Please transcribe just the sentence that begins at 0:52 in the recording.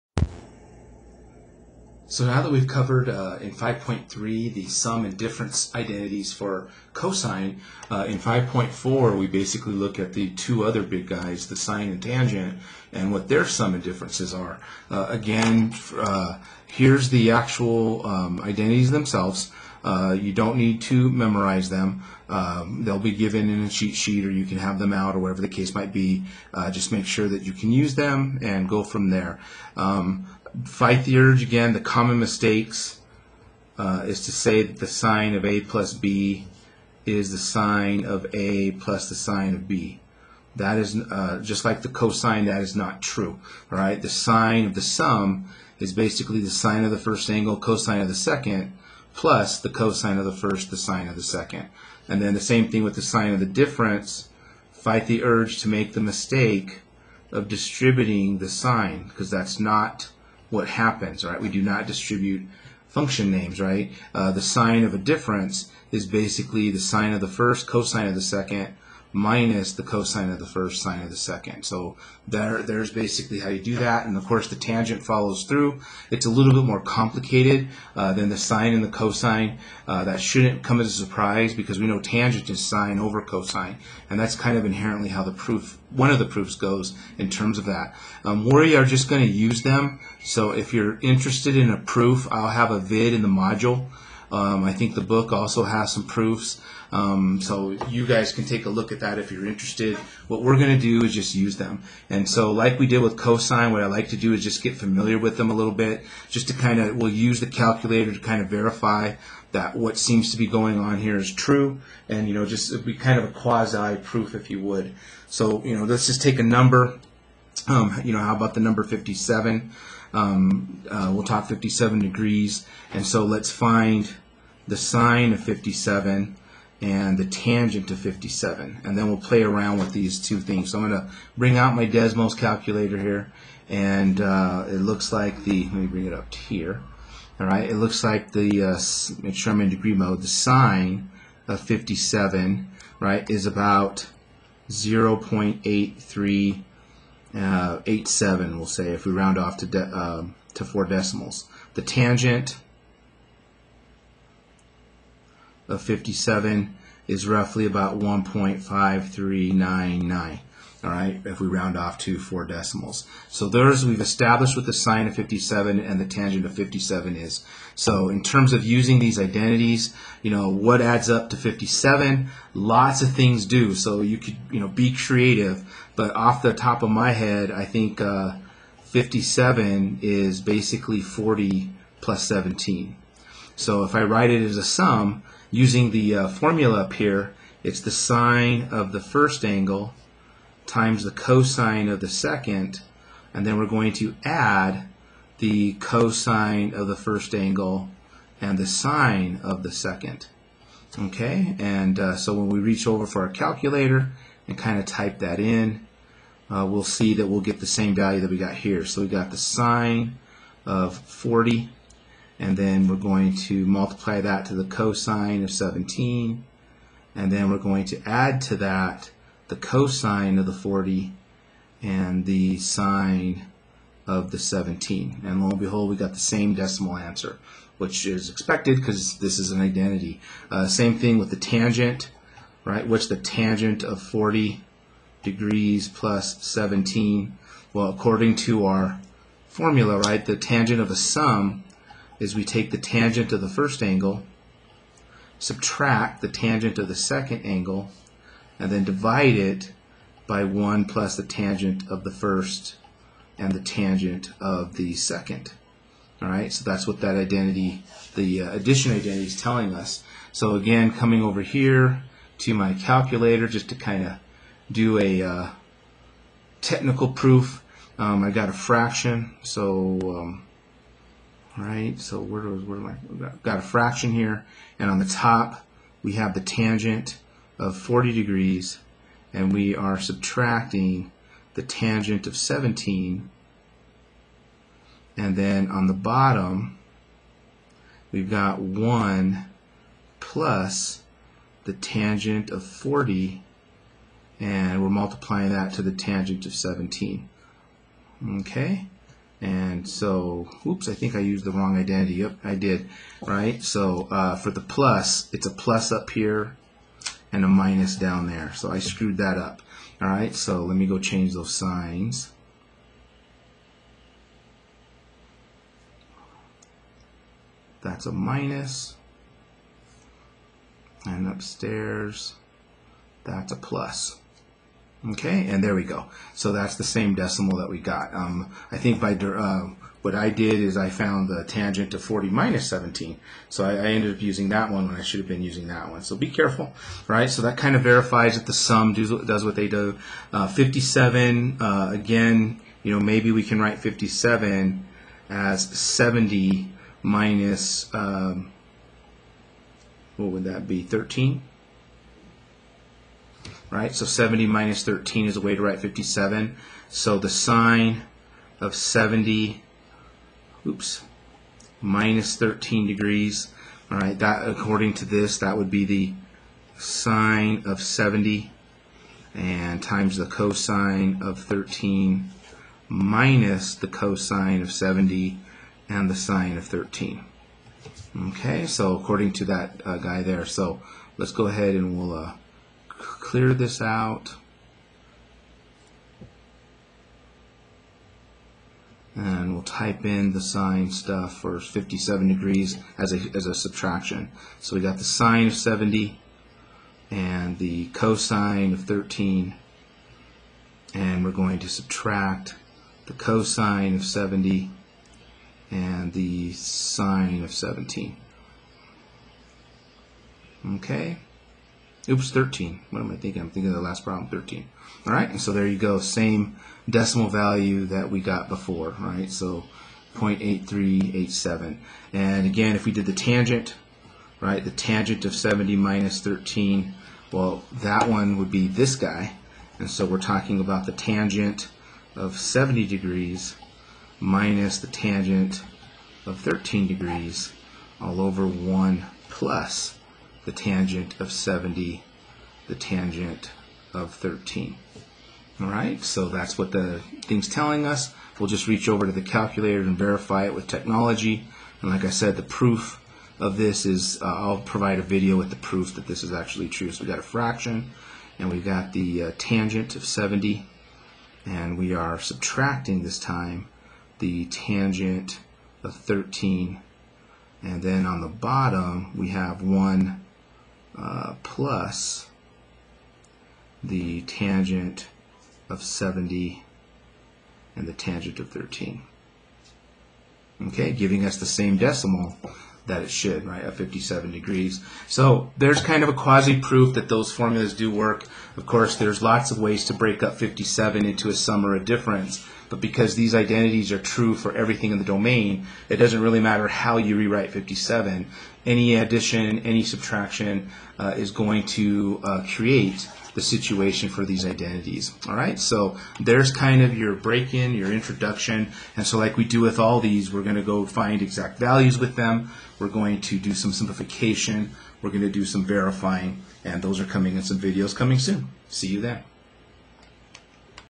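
And then the same thing with the sine of the difference.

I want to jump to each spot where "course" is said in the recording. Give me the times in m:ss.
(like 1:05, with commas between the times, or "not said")
1:14, 8:08.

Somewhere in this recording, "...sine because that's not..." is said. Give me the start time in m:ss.
0:58.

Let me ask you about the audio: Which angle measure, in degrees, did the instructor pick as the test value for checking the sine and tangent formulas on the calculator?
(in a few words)
57.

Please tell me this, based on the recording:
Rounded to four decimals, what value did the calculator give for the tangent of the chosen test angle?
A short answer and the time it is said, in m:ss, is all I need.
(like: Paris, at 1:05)
1.5399, at 2:37.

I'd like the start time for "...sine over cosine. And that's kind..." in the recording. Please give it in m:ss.
1:22.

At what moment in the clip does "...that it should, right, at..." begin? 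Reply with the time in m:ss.
8:02.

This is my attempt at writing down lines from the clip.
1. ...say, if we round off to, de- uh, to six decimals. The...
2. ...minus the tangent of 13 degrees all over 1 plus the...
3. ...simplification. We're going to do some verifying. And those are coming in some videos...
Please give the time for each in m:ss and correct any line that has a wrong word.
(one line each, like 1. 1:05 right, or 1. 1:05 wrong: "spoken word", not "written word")
1. 2:28 wrong: "four", not "six"
2. 7:14 right
3. 8:33 right.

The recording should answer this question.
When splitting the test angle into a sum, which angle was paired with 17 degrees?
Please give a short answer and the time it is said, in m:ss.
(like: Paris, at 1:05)
40, at 3:01.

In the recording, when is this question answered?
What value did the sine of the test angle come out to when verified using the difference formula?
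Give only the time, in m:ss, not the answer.
7:00.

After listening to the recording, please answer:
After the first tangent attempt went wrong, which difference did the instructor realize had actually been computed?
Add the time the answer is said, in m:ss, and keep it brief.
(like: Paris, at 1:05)
40 minus 17, at 5:31.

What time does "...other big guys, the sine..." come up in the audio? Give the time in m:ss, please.
0:10.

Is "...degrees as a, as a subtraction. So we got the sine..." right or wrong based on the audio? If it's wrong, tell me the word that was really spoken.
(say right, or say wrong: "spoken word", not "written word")
right.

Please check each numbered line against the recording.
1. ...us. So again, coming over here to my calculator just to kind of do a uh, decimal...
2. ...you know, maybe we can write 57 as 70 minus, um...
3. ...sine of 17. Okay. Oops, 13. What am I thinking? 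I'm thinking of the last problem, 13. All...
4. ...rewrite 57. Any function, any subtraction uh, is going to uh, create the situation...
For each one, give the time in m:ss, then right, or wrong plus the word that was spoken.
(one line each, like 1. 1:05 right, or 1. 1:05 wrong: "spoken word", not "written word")
1. 4:19 wrong: "technical", not "decimal"
2. 5:42 right
3. 6:46 right
4. 8:17 wrong: "addition", not "function".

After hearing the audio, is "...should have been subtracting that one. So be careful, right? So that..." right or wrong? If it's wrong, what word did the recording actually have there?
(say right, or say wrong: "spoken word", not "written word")
wrong: "using", not "subtracting".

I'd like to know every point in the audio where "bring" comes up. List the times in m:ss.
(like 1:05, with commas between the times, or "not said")
2:11, 2:15.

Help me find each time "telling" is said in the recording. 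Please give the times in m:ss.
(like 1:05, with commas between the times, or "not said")
4:19, 7:27.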